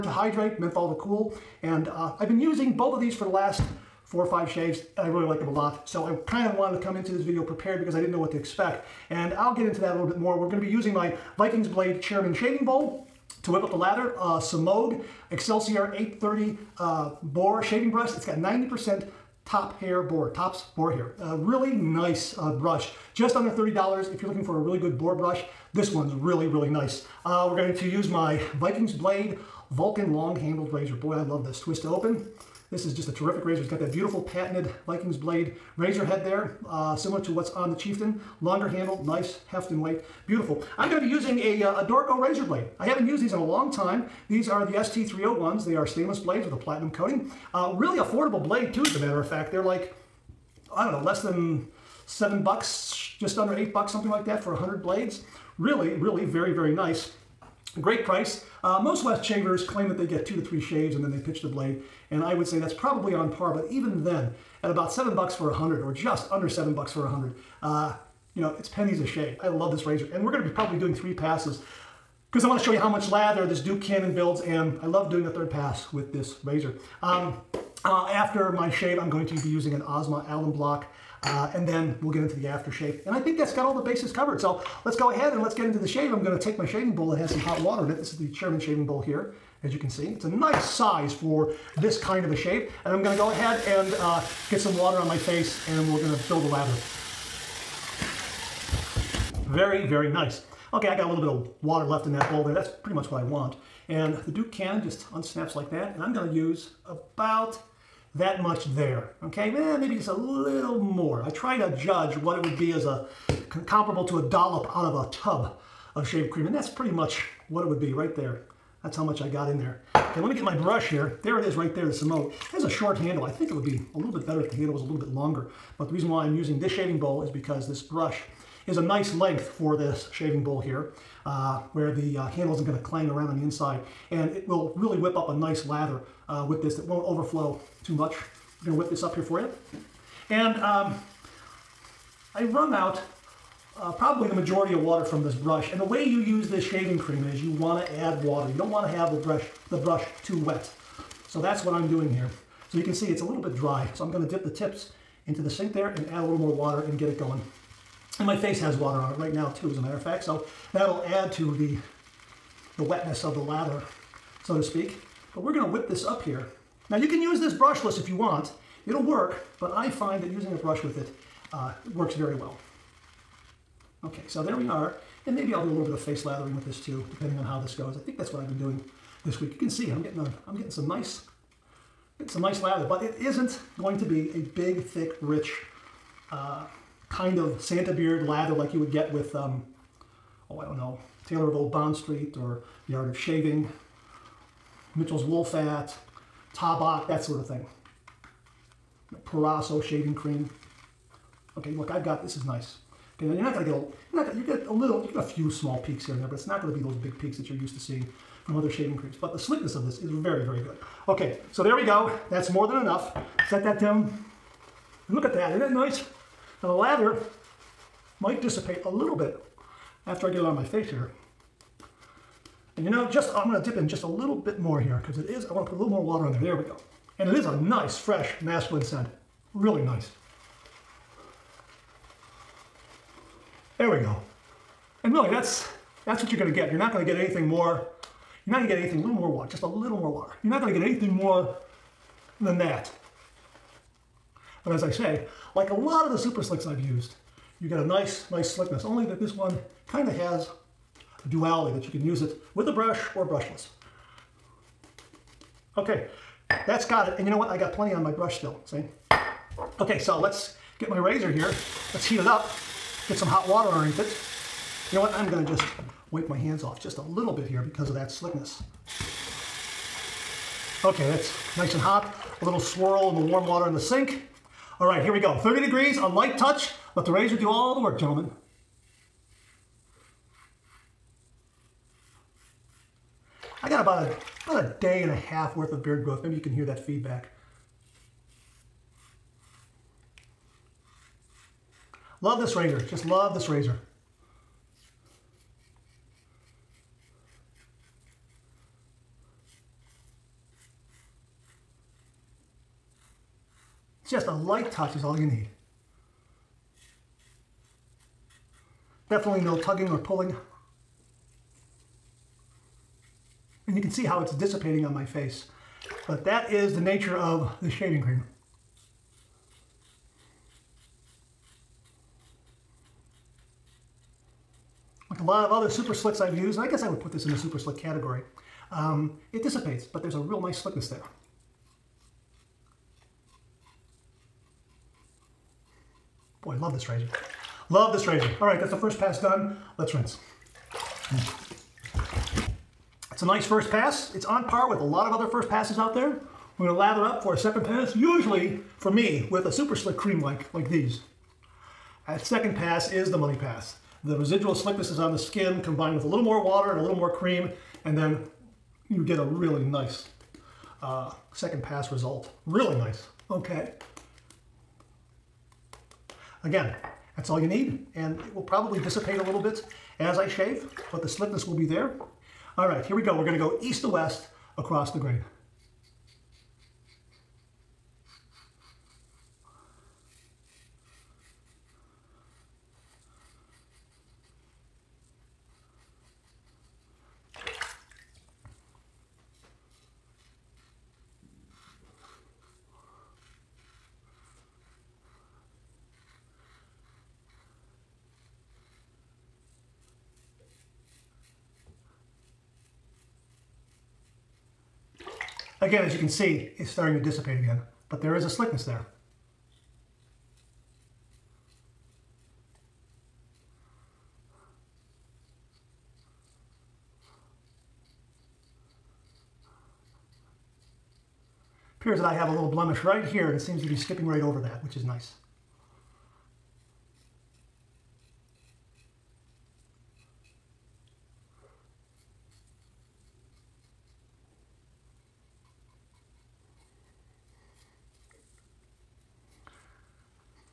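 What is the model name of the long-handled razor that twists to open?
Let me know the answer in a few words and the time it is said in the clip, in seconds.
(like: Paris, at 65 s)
Vulcan, at 29 s.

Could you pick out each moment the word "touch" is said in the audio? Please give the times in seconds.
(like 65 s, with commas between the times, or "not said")
276 s, 304 s.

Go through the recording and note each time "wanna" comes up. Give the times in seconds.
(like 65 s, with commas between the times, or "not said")
72 s, 225 s.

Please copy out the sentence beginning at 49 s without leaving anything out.
They're like, I don't know, less than seven bucks, just under eight bucks, something like that for a 100 blades.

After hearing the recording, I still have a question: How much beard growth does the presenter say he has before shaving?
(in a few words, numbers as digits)
a day and a half.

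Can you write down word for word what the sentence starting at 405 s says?
Again, as you can see, it's starting to dissipate again, but there is a slickness there.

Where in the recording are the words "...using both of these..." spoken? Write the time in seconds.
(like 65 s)
2 s.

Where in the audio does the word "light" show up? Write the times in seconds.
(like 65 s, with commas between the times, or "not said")
276 s, 304 s.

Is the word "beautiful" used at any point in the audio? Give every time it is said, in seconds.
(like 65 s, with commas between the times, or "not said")
33 s, 40 s.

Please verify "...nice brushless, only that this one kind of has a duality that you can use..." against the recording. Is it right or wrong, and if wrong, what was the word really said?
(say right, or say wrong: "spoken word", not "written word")
wrong: "slickness", not "brushless".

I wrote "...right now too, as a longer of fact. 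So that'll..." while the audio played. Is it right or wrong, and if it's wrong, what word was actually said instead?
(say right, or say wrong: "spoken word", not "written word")
wrong: "matter", not "longer".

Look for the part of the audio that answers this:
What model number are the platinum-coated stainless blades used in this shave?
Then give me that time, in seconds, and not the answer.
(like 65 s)
44 s.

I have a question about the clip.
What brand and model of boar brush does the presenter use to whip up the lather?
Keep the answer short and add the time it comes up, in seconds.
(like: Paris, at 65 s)
Semogue Excelsior 830, at 14 s.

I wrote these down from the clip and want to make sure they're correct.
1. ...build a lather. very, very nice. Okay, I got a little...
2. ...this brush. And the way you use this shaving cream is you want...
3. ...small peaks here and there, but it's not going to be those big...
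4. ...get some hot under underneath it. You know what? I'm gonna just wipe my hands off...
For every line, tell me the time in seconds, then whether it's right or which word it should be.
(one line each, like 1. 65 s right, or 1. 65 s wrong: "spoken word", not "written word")
1. 96 s right
2. 145 s right
3. 205 s right
4. 263 s wrong: "water", not "under".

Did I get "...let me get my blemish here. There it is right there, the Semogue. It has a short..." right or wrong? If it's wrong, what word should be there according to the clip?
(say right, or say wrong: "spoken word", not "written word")
wrong: "brush", not "blemish".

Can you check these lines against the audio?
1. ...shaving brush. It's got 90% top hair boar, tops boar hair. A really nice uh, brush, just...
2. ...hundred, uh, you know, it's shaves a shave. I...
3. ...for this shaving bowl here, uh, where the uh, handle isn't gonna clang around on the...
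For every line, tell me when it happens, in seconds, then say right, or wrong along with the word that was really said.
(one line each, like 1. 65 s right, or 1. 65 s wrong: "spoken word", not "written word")
1. 17 s right
2. 67 s wrong: "pennies", not "shaves"
3. 129 s right.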